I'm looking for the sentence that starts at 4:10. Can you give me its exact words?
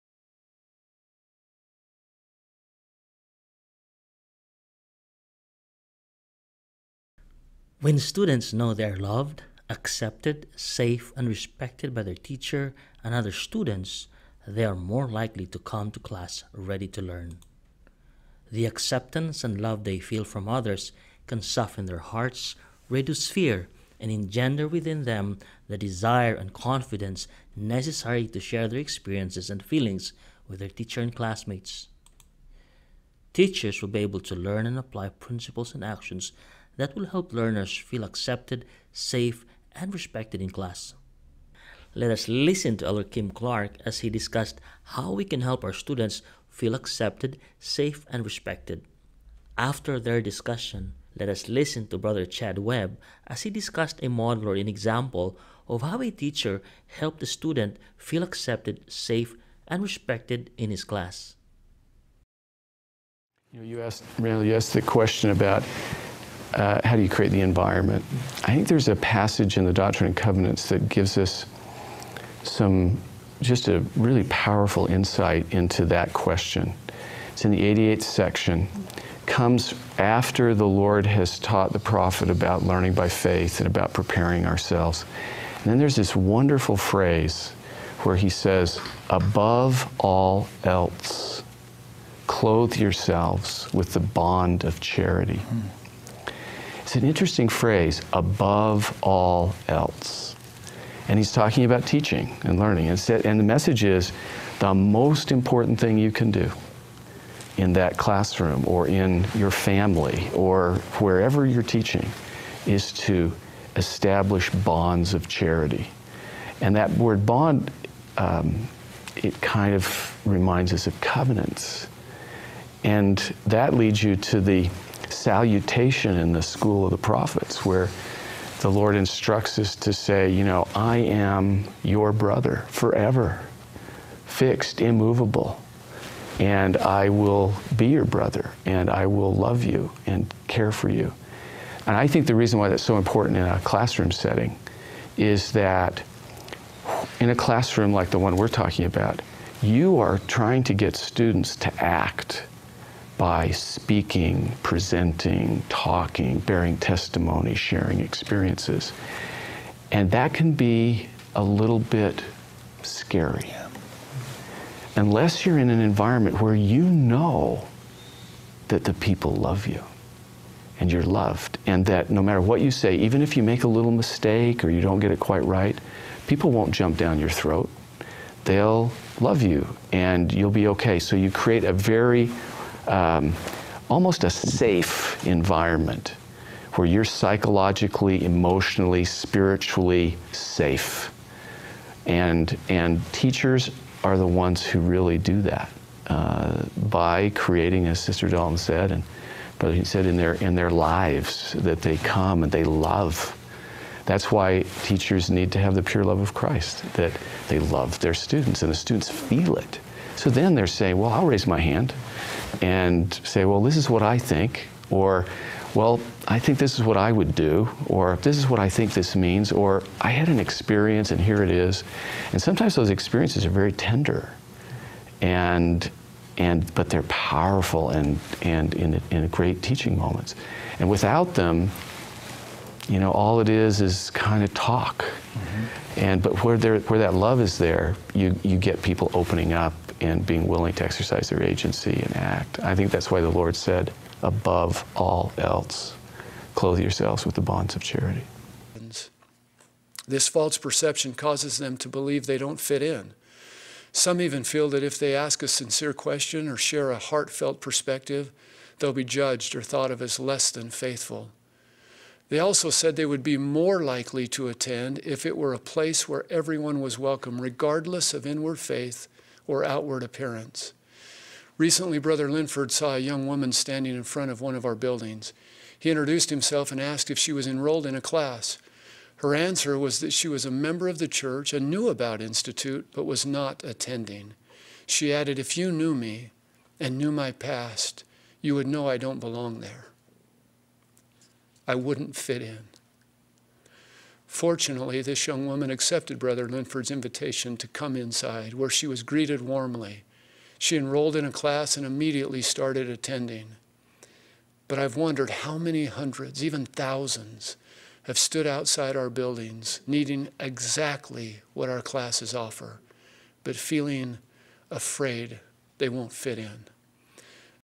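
This false perception causes them to believe they don't fit in.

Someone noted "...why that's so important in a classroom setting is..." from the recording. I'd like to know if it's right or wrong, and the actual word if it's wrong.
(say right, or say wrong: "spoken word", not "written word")
right.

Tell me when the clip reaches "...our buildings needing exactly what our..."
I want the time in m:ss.
5:08.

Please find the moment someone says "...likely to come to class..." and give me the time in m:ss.
0:15.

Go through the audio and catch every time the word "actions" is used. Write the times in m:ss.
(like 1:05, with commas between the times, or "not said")
0:35.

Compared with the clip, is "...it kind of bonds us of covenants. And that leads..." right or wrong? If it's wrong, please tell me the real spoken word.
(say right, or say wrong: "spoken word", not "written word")
wrong: "reminds", not "bonds".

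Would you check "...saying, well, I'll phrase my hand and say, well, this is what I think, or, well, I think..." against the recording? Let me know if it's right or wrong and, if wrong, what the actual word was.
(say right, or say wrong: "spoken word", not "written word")
wrong: "raise", not "phrase".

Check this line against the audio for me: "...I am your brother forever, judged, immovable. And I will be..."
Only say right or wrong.
wrong.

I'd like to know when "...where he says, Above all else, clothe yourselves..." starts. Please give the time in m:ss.
1:28.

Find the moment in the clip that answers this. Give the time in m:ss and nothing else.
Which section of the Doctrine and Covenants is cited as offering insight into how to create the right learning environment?
1:17.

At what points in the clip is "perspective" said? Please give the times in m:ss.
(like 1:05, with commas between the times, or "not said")
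4:17.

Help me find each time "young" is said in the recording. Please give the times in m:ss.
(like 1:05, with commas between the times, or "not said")
4:32, 4:55.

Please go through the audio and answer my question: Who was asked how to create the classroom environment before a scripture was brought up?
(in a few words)
Randall.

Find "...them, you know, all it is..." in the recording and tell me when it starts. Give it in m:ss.
3:51.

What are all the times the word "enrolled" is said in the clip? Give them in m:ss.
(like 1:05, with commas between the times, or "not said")
4:37, 5:00.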